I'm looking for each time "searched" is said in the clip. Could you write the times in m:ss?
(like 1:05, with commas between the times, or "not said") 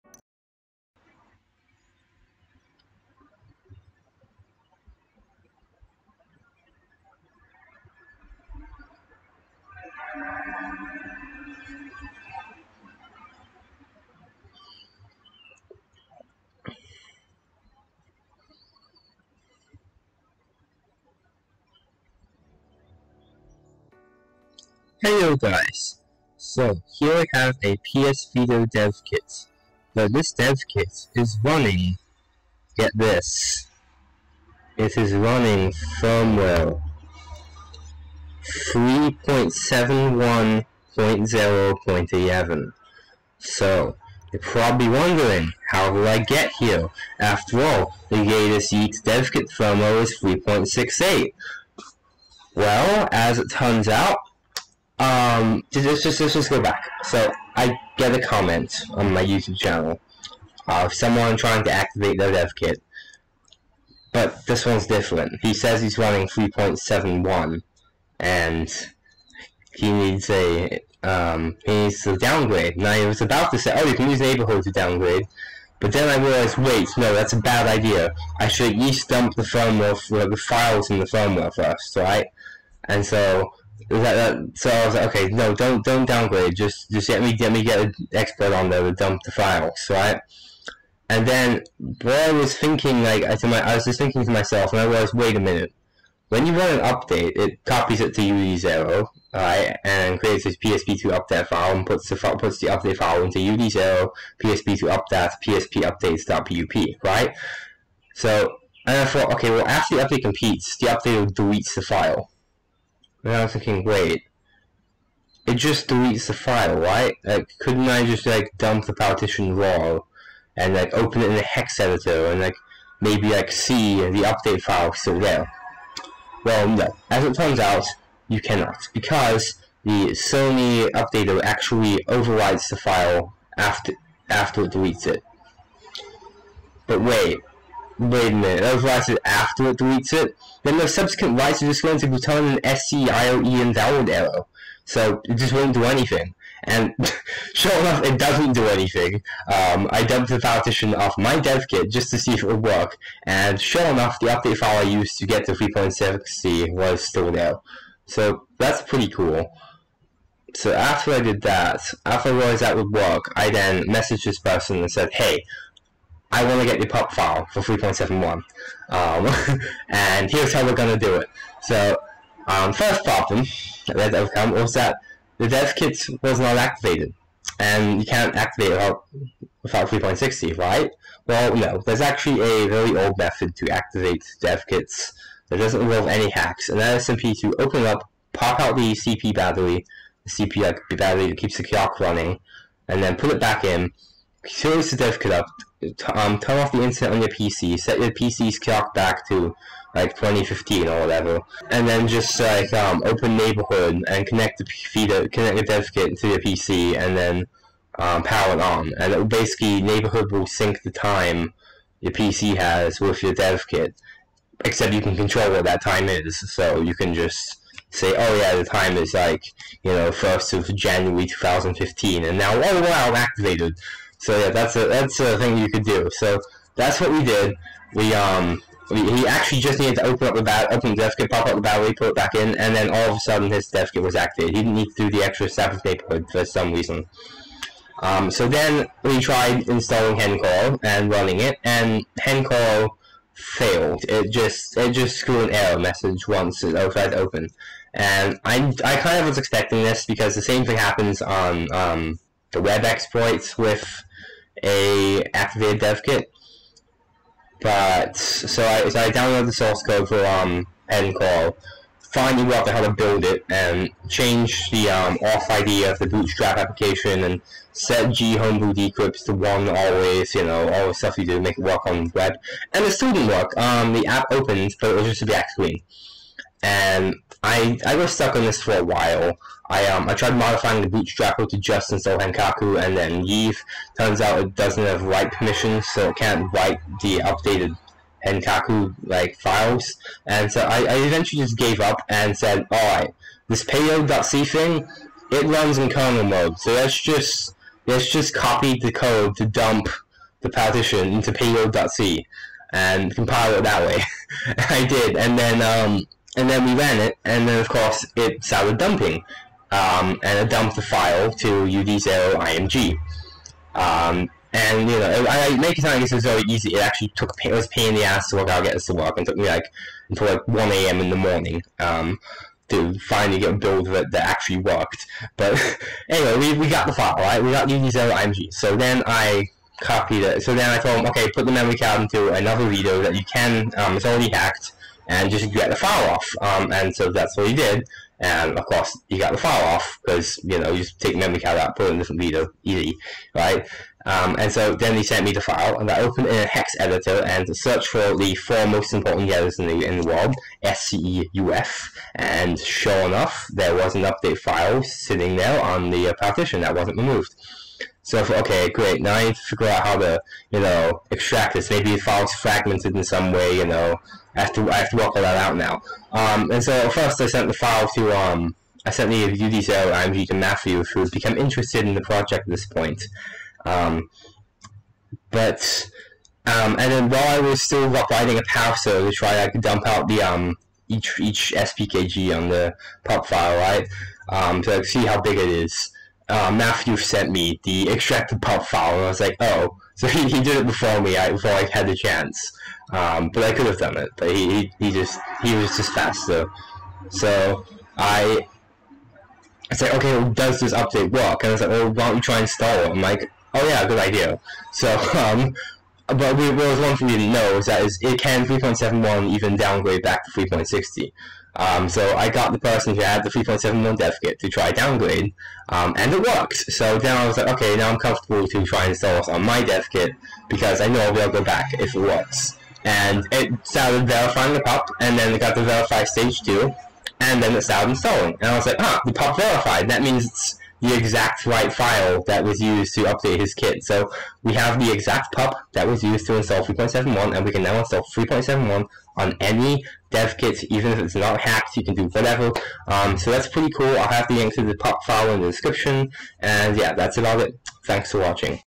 5:47.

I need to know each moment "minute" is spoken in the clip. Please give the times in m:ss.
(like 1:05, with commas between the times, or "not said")
1:35, 2:18.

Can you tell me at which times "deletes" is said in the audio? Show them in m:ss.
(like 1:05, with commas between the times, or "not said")
1:51, 1:55, 2:14, 2:19.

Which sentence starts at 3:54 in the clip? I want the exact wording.
He didn't need to do the extra step of neighborhood for some reason.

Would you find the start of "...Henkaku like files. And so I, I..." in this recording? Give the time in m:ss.
4:48.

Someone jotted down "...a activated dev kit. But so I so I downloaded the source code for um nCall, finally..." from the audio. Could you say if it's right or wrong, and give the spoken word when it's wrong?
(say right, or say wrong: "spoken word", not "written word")
right.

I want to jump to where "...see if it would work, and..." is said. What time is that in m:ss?
2:32.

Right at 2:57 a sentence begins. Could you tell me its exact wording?
And you can't activate it without, without 3.60, right?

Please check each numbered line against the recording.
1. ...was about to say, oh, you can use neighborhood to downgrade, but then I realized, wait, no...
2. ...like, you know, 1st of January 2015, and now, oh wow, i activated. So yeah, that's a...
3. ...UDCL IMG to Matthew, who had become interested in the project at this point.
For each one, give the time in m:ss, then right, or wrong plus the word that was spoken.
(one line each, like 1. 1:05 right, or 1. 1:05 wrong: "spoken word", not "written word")
1. 1:13 right
2. 3:39 right
3. 6:09 right.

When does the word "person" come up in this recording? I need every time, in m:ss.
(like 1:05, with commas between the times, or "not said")
2:44, 6:52.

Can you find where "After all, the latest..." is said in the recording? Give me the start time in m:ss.
0:47.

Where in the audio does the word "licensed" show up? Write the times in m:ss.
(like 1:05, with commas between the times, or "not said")
2:18.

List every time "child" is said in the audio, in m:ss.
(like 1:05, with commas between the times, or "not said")
not said.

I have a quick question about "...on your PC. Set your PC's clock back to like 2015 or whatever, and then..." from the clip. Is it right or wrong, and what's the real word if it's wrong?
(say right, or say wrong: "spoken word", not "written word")
right.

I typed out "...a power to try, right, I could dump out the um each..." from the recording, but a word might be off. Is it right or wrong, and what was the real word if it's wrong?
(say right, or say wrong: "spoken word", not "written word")
right.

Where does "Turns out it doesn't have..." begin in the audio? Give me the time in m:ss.
4:43.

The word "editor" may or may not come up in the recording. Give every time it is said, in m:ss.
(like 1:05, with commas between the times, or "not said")
2:01, 5:46.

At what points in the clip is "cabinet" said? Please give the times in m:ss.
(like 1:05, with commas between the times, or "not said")
not said.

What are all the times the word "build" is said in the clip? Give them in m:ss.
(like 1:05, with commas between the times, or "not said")
4:22, 5:23.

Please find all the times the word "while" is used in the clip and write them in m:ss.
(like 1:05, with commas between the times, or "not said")
4:38, 6:17.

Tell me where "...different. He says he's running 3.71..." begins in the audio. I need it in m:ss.
1:04.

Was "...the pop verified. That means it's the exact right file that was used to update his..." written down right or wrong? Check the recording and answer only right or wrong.
right.